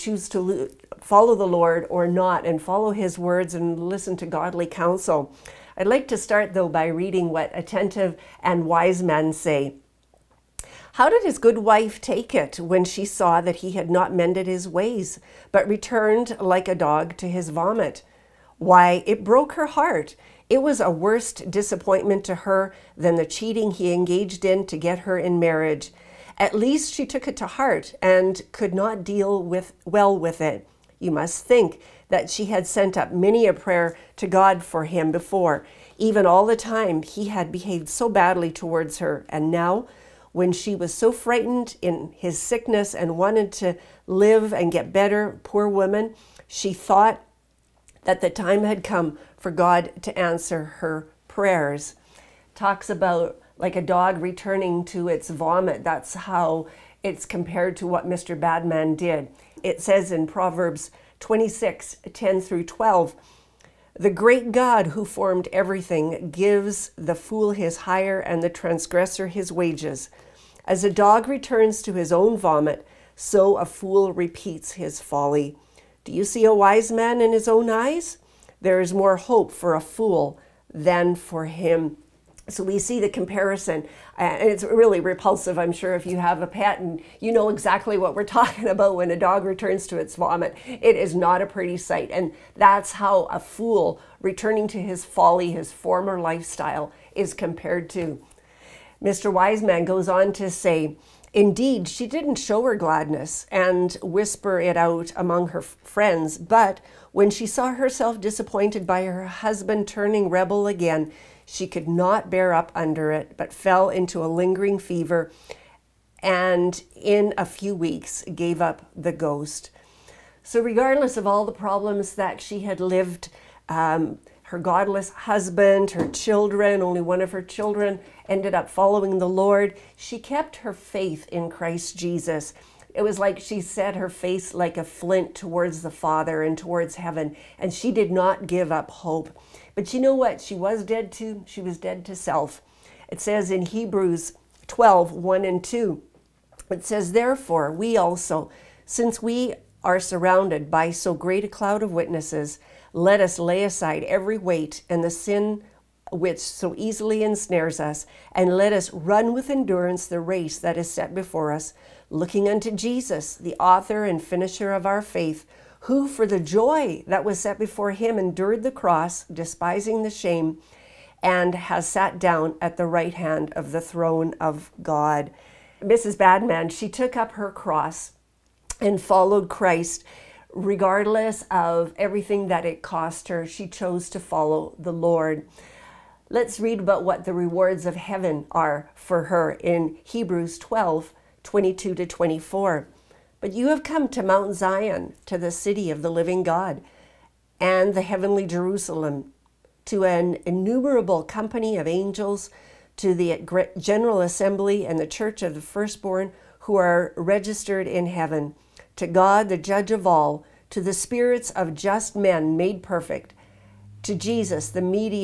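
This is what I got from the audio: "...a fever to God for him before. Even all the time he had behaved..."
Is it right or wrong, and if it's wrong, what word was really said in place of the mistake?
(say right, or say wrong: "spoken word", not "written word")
wrong: "prayer", not "fever".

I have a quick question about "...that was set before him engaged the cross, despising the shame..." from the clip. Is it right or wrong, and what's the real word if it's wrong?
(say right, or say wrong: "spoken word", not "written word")
wrong: "endured", not "engaged".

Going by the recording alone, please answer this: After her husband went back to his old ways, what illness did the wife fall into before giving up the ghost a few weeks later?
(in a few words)
A lingering fever.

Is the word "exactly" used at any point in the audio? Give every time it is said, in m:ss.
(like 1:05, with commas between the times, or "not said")
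1:27.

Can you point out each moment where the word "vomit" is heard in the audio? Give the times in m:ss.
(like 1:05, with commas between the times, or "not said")
0:17, 0:55, 1:12, 1:30.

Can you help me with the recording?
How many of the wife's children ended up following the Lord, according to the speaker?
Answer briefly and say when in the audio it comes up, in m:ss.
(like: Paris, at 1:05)
1, at 2:06.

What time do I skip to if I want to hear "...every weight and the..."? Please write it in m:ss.
2:34.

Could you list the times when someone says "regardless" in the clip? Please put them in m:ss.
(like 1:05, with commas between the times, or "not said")
2:00, 3:00.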